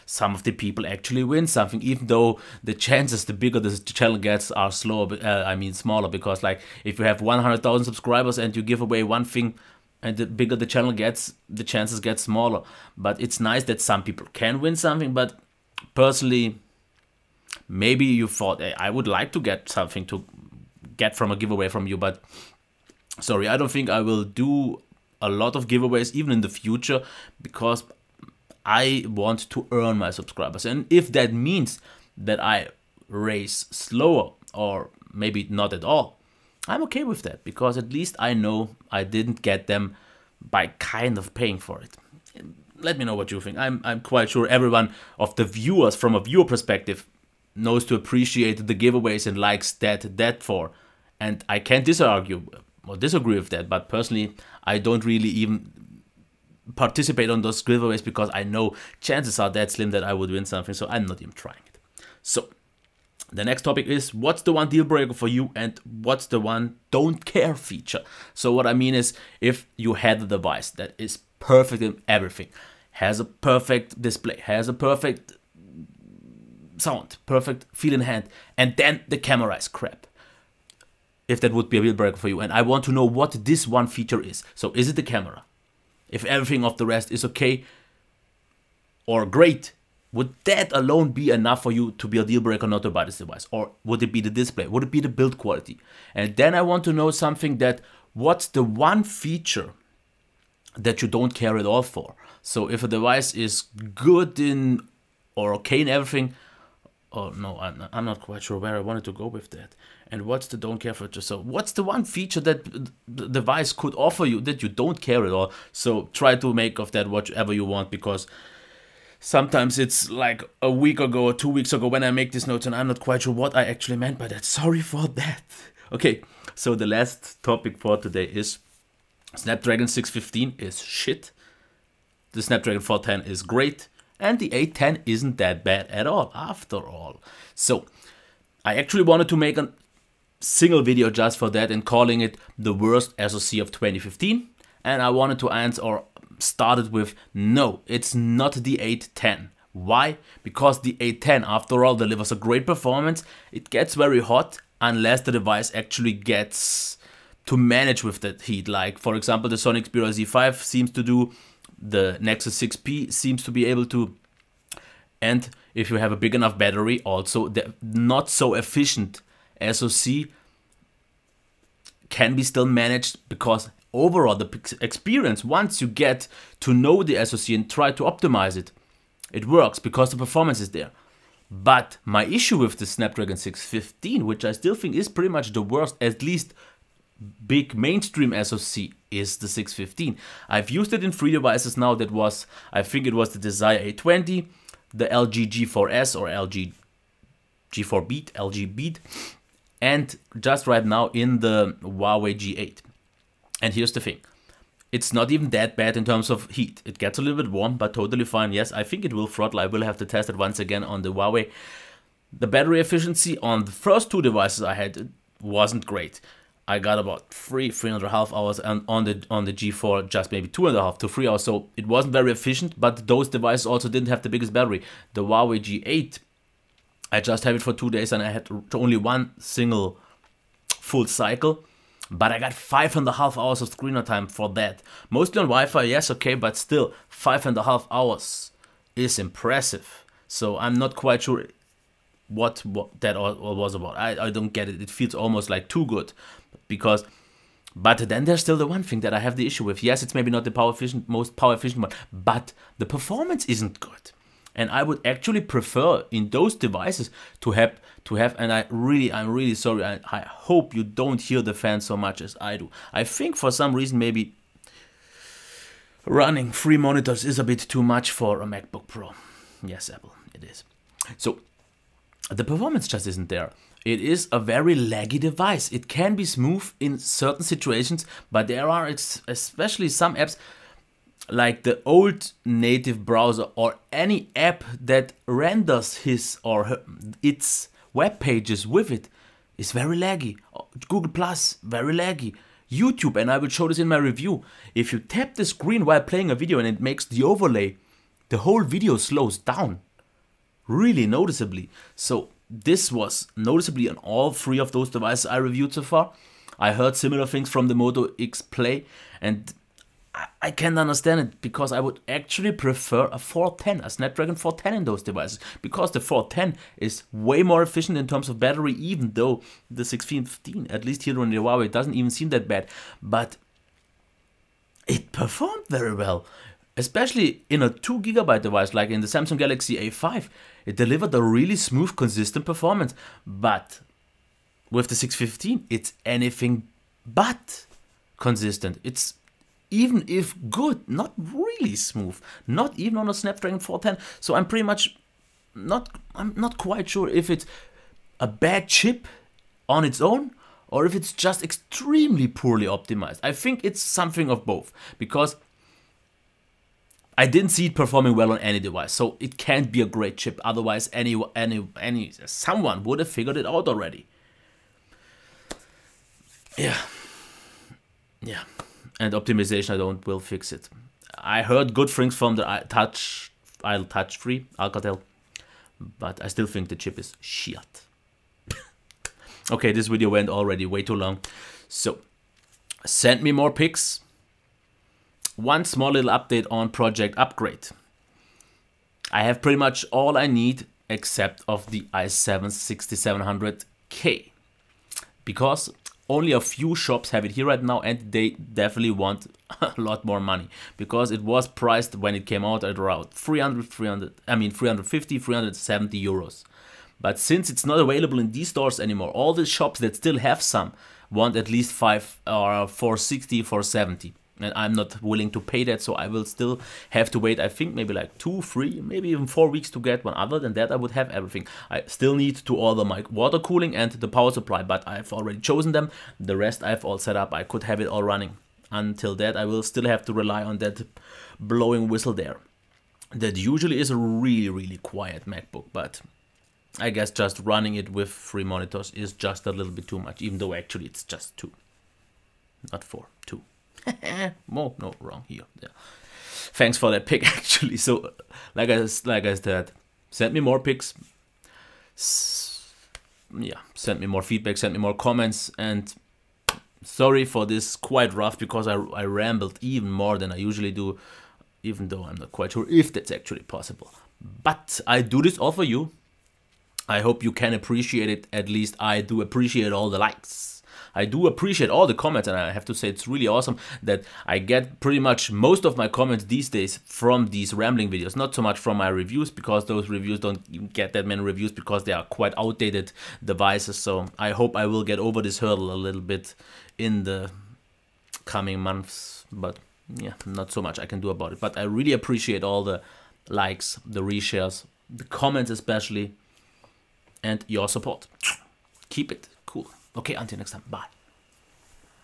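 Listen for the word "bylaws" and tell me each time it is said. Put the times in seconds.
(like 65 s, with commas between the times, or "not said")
not said.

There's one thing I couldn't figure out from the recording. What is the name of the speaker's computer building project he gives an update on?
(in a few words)
Project Upgrade.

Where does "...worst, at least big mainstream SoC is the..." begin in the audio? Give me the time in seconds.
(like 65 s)
185 s.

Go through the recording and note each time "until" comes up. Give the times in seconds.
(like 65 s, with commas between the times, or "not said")
428 s, 500 s.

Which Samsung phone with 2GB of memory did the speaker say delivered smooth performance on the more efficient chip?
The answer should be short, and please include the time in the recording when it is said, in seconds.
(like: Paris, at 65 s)
Samsung Galaxy A5, at 329 s.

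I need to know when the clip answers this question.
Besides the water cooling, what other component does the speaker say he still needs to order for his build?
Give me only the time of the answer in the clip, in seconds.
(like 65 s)
424 s.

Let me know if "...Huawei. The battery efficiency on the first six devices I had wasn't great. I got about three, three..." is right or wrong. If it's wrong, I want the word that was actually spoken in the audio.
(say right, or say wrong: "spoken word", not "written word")
wrong: "two", not "six".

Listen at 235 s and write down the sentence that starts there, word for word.
Mostly on Wi-Fi, yes, okay, but still five and a half hours is impressive.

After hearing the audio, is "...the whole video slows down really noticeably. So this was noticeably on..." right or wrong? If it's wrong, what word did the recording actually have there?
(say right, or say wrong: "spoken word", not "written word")
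right.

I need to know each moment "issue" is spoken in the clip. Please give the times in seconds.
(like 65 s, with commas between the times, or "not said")
182 s, 249 s.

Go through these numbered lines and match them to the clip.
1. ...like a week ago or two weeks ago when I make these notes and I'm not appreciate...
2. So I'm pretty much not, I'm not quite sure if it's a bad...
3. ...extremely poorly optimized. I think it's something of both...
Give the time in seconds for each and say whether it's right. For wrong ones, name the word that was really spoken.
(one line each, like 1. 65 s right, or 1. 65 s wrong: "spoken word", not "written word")
1. 120 s wrong: "quite", not "appreciate"
2. 344 s right
3. 351 s right.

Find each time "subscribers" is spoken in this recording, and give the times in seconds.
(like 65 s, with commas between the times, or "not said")
7 s, 30 s.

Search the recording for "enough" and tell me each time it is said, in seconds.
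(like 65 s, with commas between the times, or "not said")
91 s, 166 s.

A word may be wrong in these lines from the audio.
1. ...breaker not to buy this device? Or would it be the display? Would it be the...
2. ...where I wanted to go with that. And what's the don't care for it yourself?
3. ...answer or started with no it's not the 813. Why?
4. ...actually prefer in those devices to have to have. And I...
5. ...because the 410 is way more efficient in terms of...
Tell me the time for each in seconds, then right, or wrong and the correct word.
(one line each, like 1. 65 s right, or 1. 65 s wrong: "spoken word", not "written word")
1. 92 s right
2. 108 s right
3. 145 s wrong: "810", not "813"
4. 255 s right
5. 315 s right.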